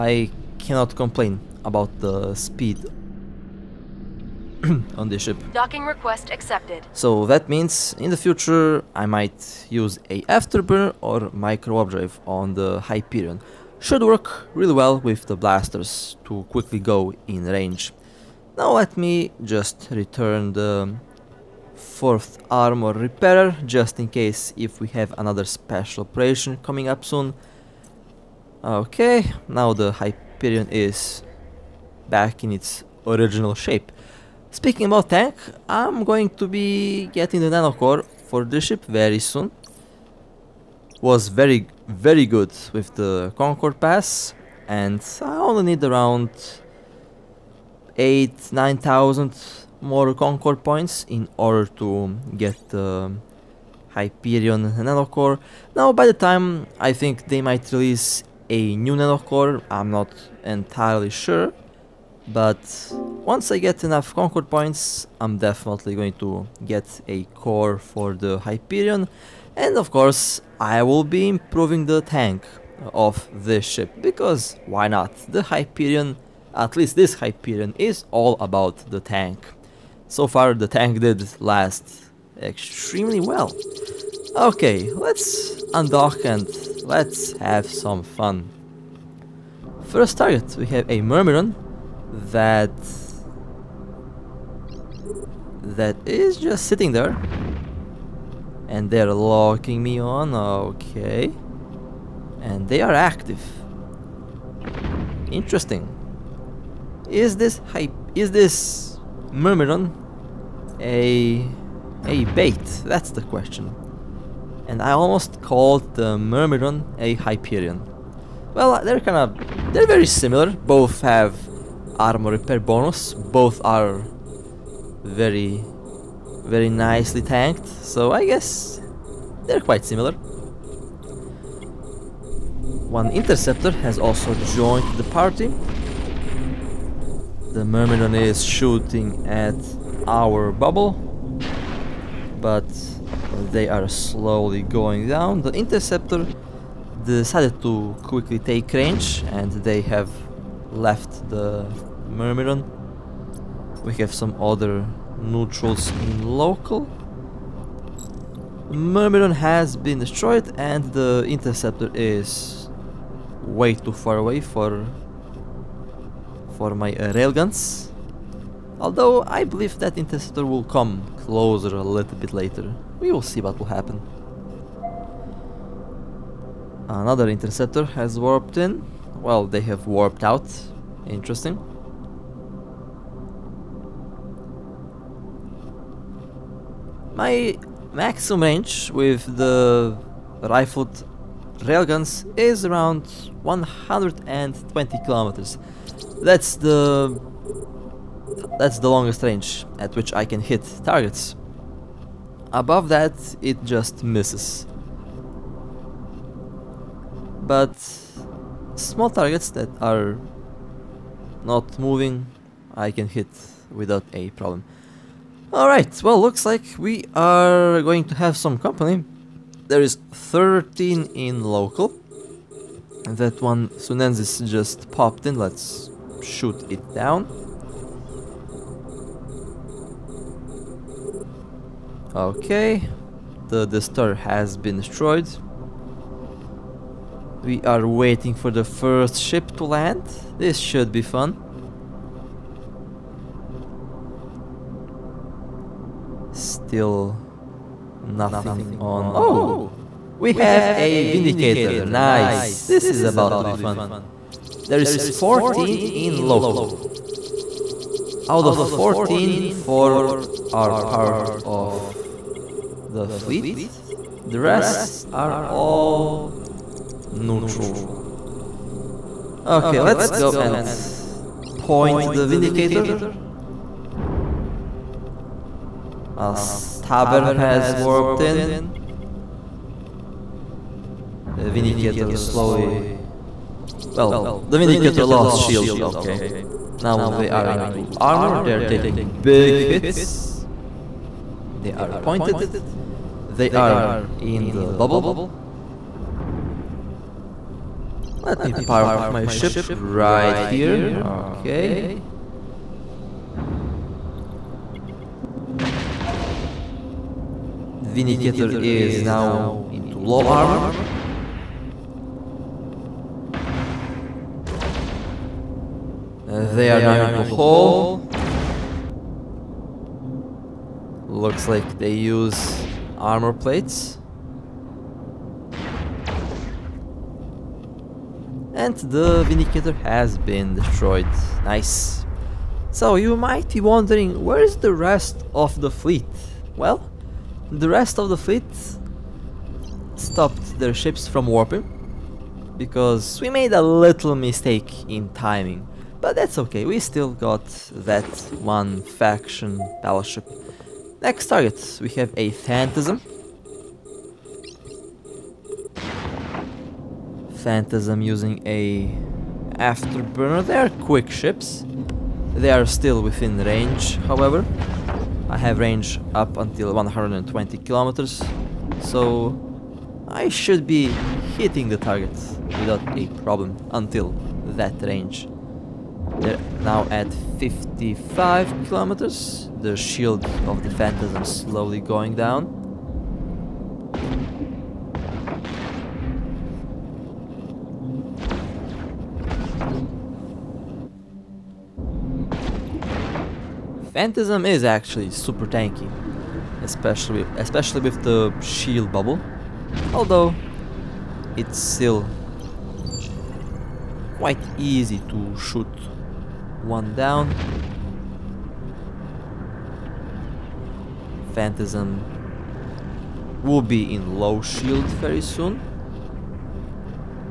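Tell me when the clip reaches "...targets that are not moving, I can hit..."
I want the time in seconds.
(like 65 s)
209 s.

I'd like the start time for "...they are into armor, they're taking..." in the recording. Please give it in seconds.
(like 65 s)
287 s.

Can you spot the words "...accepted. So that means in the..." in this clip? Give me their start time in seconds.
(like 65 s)
6 s.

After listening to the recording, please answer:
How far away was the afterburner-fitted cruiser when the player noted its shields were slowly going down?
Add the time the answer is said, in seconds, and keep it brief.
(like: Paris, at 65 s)
55 kilometers, at 377 s.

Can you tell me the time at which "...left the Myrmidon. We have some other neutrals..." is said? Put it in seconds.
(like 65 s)
150 s.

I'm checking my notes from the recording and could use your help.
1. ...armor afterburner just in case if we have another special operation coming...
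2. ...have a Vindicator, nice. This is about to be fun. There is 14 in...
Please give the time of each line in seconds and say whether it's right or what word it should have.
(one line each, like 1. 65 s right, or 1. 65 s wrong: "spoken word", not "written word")
1. 22 s wrong: "repairer", not "afterburner"
2. 250 s right.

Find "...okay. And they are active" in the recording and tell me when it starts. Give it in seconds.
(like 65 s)
100 s.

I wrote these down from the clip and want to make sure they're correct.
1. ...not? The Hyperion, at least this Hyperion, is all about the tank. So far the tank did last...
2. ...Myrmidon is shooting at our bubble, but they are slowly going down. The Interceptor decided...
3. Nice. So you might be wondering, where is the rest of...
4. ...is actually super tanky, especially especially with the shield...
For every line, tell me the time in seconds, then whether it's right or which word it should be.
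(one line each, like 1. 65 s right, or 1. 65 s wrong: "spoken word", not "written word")
1. 74 s right
2. 137 s right
3. 331 s right
4. 394 s right.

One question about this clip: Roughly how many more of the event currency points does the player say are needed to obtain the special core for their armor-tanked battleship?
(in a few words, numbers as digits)
8-9000.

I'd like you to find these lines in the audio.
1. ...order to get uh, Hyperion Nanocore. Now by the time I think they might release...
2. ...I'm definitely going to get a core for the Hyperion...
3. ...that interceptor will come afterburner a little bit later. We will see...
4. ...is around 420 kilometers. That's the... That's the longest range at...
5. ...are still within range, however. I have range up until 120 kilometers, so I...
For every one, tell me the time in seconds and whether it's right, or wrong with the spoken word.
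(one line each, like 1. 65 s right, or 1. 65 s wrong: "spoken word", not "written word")
1. 51 s right
2. 65 s right
3. 169 s wrong: "closer", not "afterburner"
4. 192 s wrong: "120", not "420"
5. 362 s right.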